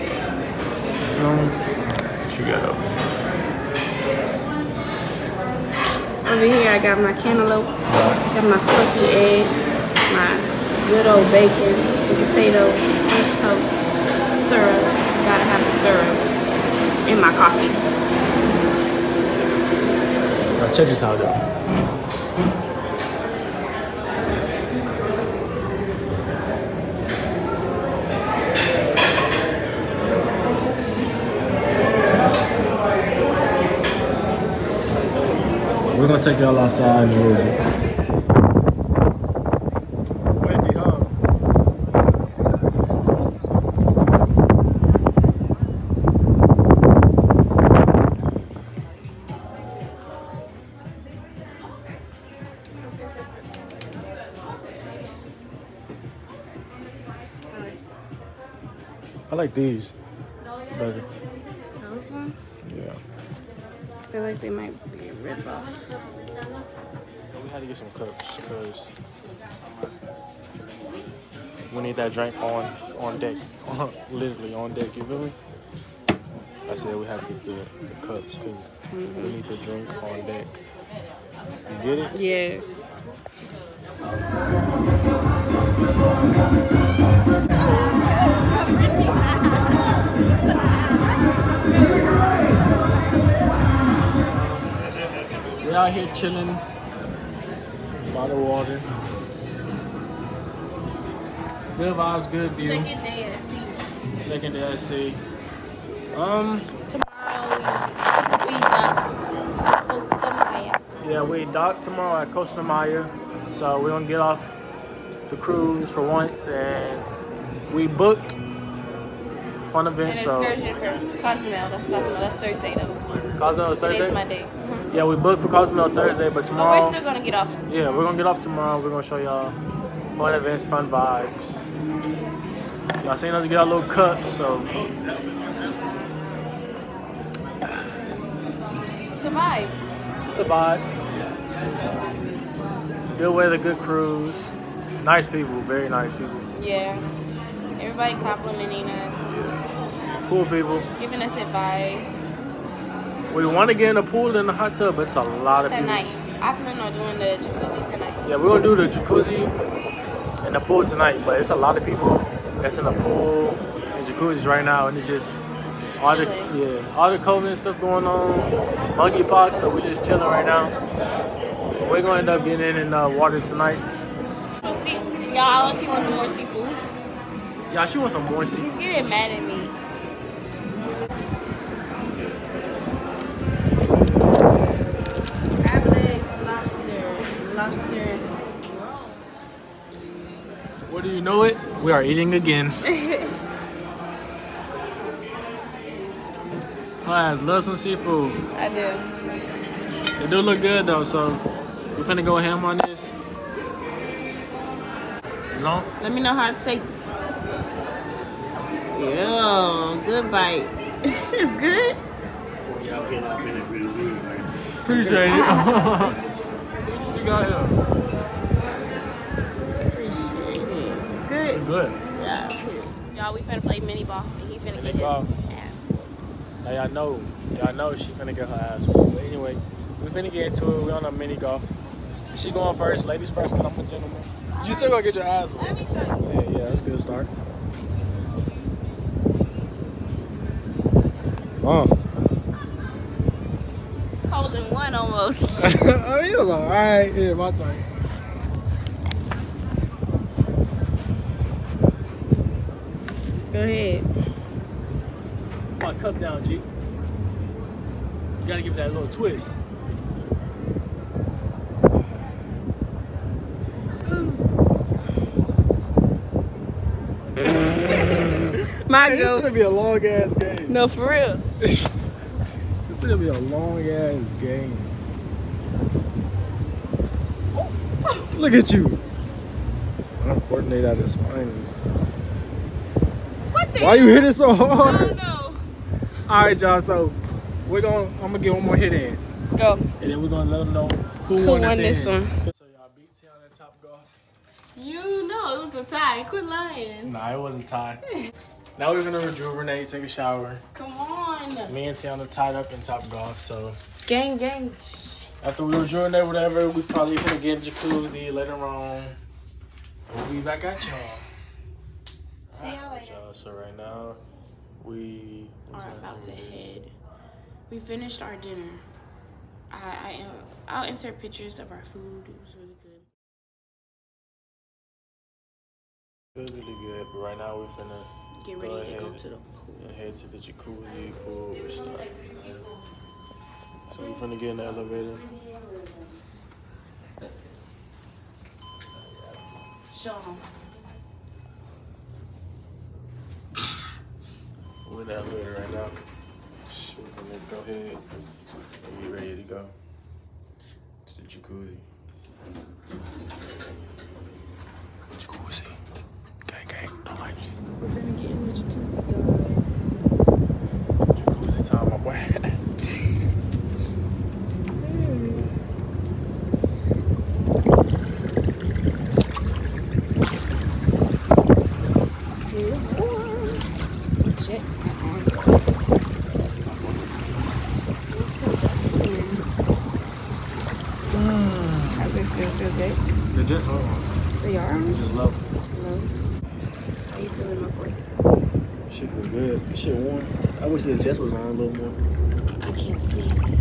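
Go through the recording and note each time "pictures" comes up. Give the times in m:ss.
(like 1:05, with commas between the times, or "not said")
5:21.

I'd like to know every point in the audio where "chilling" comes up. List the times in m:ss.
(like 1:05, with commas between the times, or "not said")
1:36, 2:50.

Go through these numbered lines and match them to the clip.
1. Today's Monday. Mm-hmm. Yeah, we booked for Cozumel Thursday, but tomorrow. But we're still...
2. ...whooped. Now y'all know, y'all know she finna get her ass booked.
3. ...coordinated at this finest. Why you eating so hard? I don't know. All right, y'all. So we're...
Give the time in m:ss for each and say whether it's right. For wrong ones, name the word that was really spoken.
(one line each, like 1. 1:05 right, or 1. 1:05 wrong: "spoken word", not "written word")
1. 2:03 right
2. 3:45 wrong: "whooped", not "booked"
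3. 4:40 wrong: "hitting", not "eating".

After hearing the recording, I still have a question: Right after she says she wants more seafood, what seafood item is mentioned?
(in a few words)
Lobster.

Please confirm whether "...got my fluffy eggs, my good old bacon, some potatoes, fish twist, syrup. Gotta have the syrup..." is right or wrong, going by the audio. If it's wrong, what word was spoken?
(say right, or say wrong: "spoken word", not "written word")
wrong: "toast", not "twist".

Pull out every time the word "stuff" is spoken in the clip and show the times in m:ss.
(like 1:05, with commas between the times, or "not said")
2:47.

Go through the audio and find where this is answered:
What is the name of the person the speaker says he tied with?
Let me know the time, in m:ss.
5:01.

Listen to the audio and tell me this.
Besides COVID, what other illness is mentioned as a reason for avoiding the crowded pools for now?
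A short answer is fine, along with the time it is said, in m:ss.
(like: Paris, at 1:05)
Monkeypox, at 2:48.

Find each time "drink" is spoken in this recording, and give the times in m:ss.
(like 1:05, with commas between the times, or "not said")
1:12, 1:19.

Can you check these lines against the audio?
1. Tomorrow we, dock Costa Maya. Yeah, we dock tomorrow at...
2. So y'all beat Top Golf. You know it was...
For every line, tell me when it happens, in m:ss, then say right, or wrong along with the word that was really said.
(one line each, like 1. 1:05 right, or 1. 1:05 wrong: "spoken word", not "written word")
1. 1:46 right
2. 4:52 right.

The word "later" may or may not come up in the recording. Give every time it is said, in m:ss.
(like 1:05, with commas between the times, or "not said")
5:08, 5:12.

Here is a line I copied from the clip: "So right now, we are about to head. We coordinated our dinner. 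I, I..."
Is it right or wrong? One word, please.
wrong.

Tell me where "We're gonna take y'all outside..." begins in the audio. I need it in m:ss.
0:35.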